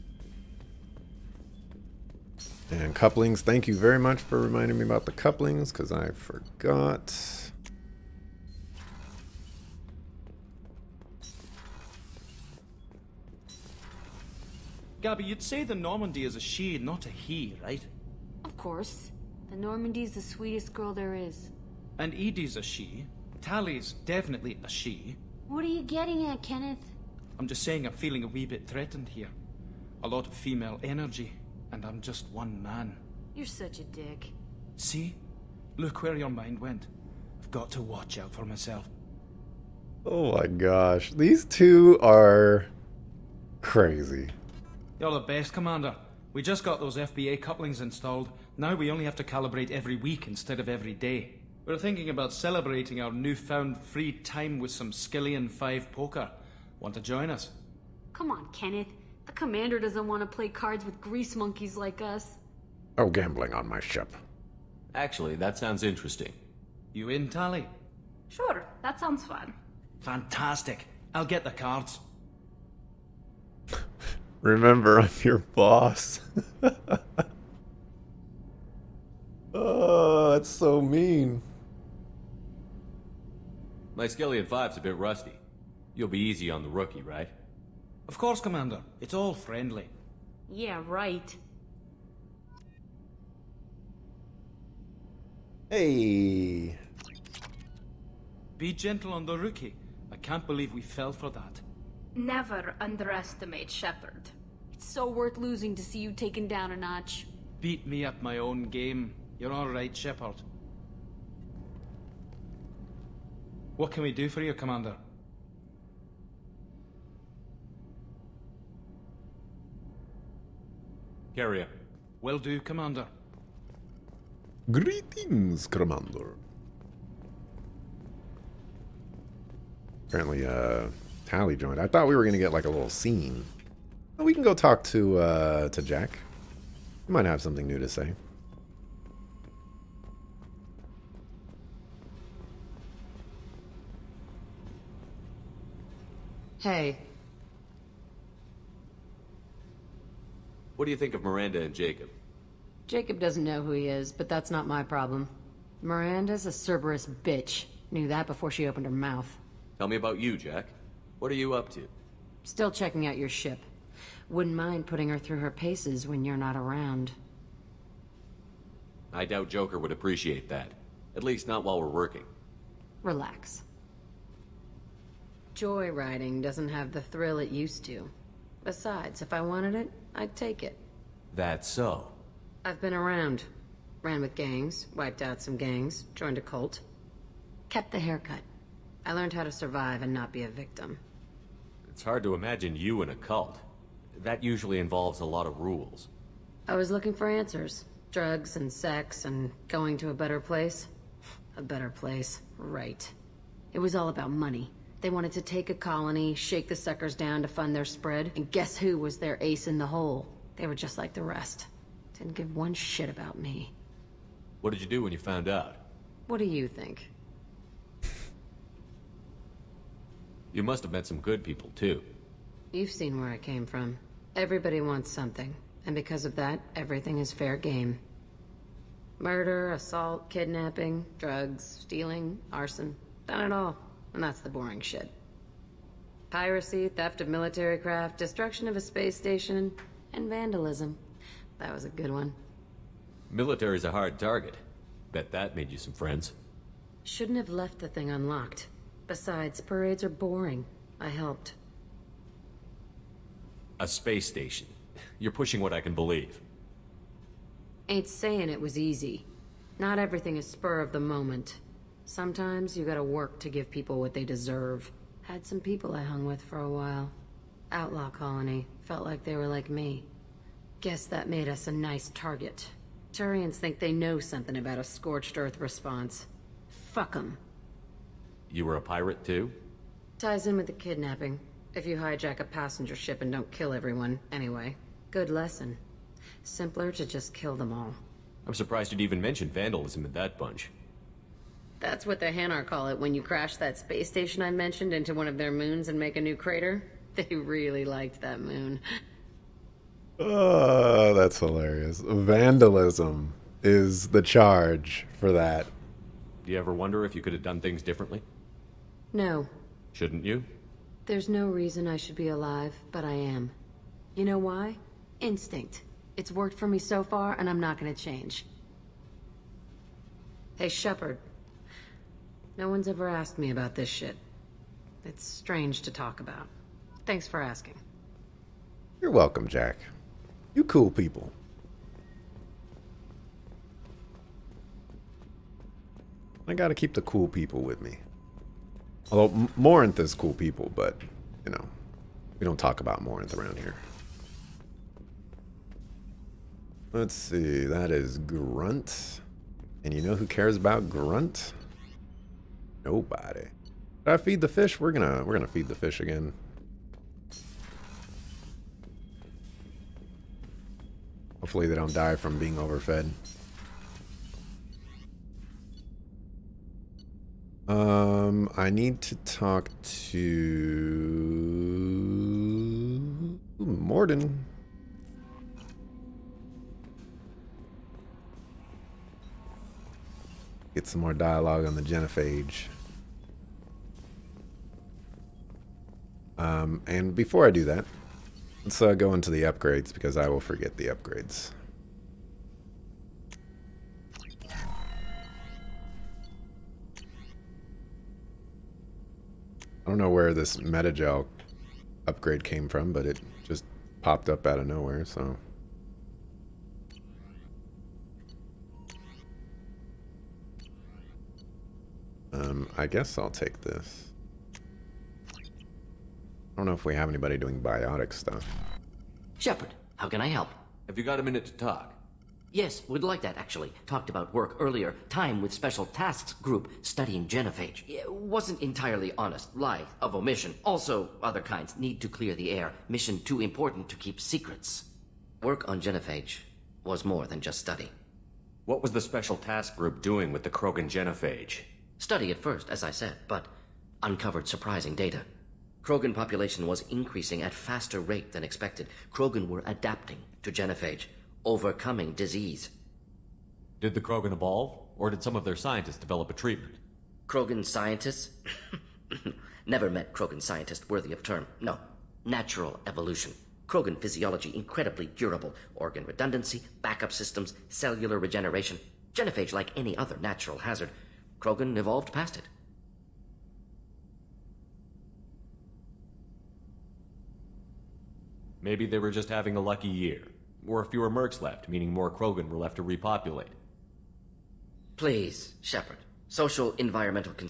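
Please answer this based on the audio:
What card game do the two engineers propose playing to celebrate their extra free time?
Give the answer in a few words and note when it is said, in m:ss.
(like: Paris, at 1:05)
Skyllian 5 poker, at 0:54.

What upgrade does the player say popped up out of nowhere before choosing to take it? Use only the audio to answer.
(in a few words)
metagel upgrade.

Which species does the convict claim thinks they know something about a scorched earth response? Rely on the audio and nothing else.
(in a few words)
Turians.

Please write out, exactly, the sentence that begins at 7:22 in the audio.
Study at first, as I said, but uncovered surprising data.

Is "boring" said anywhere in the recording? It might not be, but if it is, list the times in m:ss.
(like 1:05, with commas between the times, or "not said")
3:54, 4:10.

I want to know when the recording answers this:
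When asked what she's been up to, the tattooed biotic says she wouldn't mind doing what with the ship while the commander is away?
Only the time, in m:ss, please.
2:44.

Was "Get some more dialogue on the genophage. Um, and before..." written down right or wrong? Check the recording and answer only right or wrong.
right.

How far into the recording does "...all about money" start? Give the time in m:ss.
3:23.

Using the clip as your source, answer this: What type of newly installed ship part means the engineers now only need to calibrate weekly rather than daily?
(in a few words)
FBA couplings.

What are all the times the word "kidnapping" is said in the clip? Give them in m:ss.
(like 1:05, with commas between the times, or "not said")
3:50, 4:40.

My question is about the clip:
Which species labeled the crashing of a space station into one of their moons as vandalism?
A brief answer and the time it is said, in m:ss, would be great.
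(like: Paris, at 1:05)
Hanar, at 4:52.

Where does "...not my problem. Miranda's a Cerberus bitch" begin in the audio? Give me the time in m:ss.
2:34.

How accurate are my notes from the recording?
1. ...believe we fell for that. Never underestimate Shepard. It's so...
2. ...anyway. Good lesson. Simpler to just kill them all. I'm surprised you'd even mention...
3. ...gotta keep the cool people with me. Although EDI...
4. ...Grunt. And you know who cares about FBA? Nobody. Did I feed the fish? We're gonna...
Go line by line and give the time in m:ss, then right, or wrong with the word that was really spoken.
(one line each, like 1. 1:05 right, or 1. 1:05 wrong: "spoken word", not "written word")
1. 1:40 right
2. 4:44 right
3. 5:36 wrong: "Morinth", not "EDI"
4. 5:48 wrong: "Grunt", not "FBA".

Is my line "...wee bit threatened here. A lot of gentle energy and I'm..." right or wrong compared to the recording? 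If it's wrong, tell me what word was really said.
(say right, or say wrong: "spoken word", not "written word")
wrong: "female", not "gentle".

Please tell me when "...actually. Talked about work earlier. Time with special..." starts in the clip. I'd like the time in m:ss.
7:03.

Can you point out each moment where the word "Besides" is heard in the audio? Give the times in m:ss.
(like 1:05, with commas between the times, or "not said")
2:58, 4:09.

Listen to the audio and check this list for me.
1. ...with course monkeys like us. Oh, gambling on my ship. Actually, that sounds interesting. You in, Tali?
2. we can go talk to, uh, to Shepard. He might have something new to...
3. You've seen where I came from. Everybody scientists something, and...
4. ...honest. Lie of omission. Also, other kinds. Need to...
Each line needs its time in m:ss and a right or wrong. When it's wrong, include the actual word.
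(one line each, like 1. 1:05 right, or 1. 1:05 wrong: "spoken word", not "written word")
1. 1:00 wrong: "grease", not "course"
2. 2:14 wrong: "Jack", not "Shepard"
3. 3:42 wrong: "wants", not "scientists"
4. 7:09 right.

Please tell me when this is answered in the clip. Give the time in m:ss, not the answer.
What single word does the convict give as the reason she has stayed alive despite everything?
5:15.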